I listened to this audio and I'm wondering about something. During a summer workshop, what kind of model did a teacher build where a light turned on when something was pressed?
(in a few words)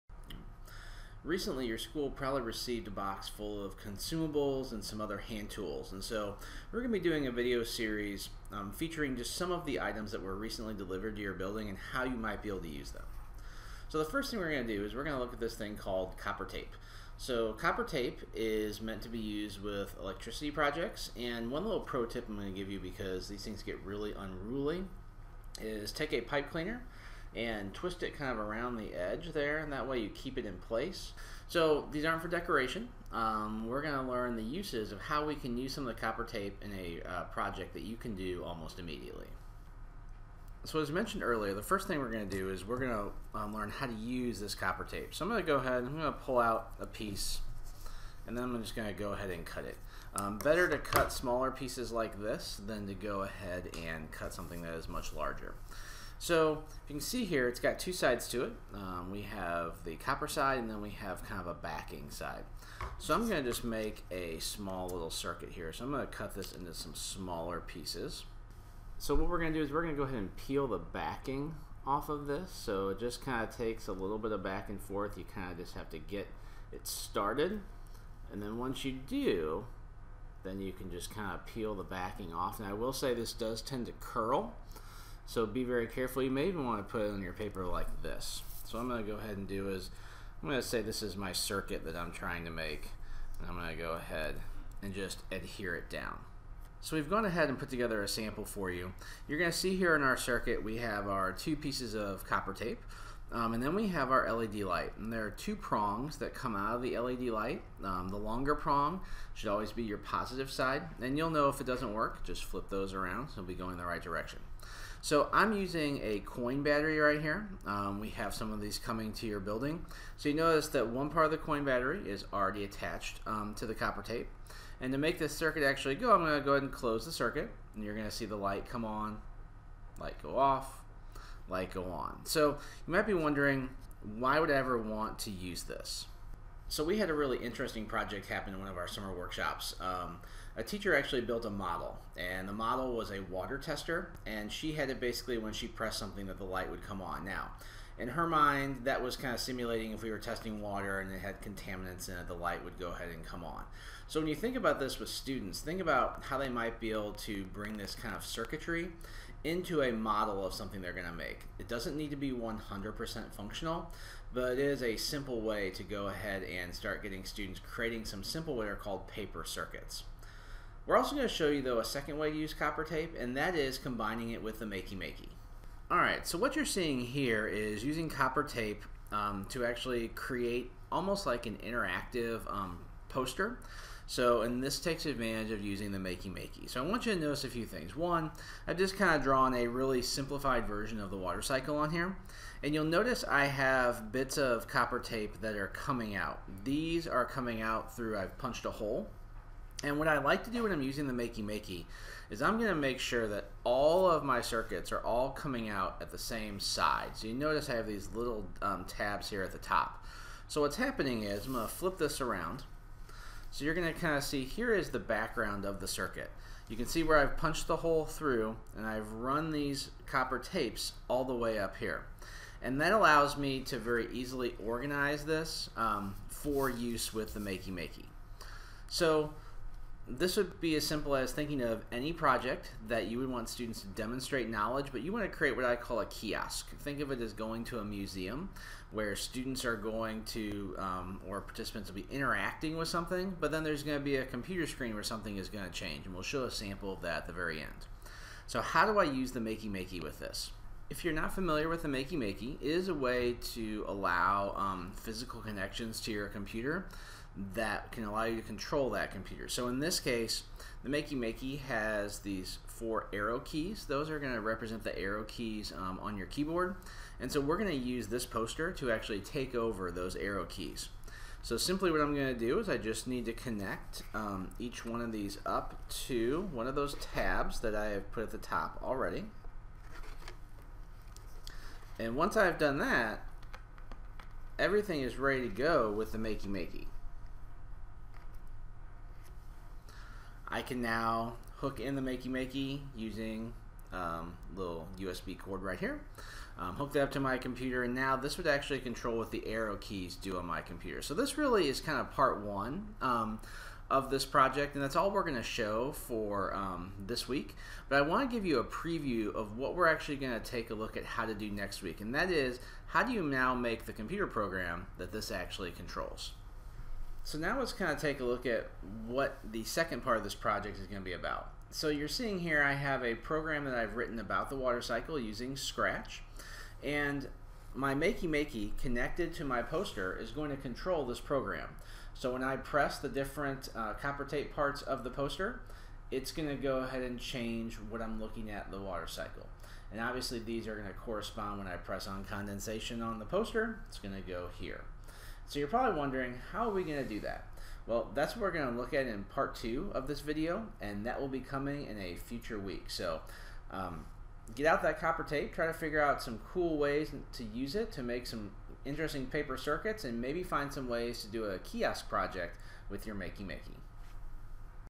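water tester.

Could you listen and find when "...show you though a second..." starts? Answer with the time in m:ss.
2:51.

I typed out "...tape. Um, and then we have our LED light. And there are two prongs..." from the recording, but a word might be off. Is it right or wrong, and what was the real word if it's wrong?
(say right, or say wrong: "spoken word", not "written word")
right.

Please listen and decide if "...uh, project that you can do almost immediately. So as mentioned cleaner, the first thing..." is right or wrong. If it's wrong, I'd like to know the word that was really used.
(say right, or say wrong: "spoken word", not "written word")
wrong: "earlier", not "cleaner".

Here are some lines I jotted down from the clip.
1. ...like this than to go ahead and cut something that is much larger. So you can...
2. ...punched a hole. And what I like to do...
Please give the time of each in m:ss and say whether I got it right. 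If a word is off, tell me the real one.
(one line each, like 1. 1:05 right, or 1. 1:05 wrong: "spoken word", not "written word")
1. 0:51 right
2. 3:18 right.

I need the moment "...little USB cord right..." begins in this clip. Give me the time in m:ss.
4:54.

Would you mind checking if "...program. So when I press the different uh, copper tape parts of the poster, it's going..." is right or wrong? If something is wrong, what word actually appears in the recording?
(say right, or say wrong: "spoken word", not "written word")
right.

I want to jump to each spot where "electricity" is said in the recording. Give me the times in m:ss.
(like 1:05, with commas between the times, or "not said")
0:20.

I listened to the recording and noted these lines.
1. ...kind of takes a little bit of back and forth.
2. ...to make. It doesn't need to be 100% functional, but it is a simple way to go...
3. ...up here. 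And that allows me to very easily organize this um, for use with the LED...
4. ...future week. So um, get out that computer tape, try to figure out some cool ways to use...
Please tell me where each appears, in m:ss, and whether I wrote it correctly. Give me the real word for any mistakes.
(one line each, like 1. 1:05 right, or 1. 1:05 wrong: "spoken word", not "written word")
1. 1:13 right
2. 2:41 right
3. 3:41 wrong: "Makey", not "LED"
4. 5:52 wrong: "copper", not "computer".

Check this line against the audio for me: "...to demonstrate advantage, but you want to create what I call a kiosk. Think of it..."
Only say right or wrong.
wrong.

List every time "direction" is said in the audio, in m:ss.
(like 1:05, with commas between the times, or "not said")
1:54.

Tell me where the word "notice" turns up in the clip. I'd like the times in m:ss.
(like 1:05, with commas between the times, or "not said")
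2:00, 3:07, 3:12, 3:27.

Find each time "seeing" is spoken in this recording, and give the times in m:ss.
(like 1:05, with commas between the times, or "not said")
2:56, 5:22.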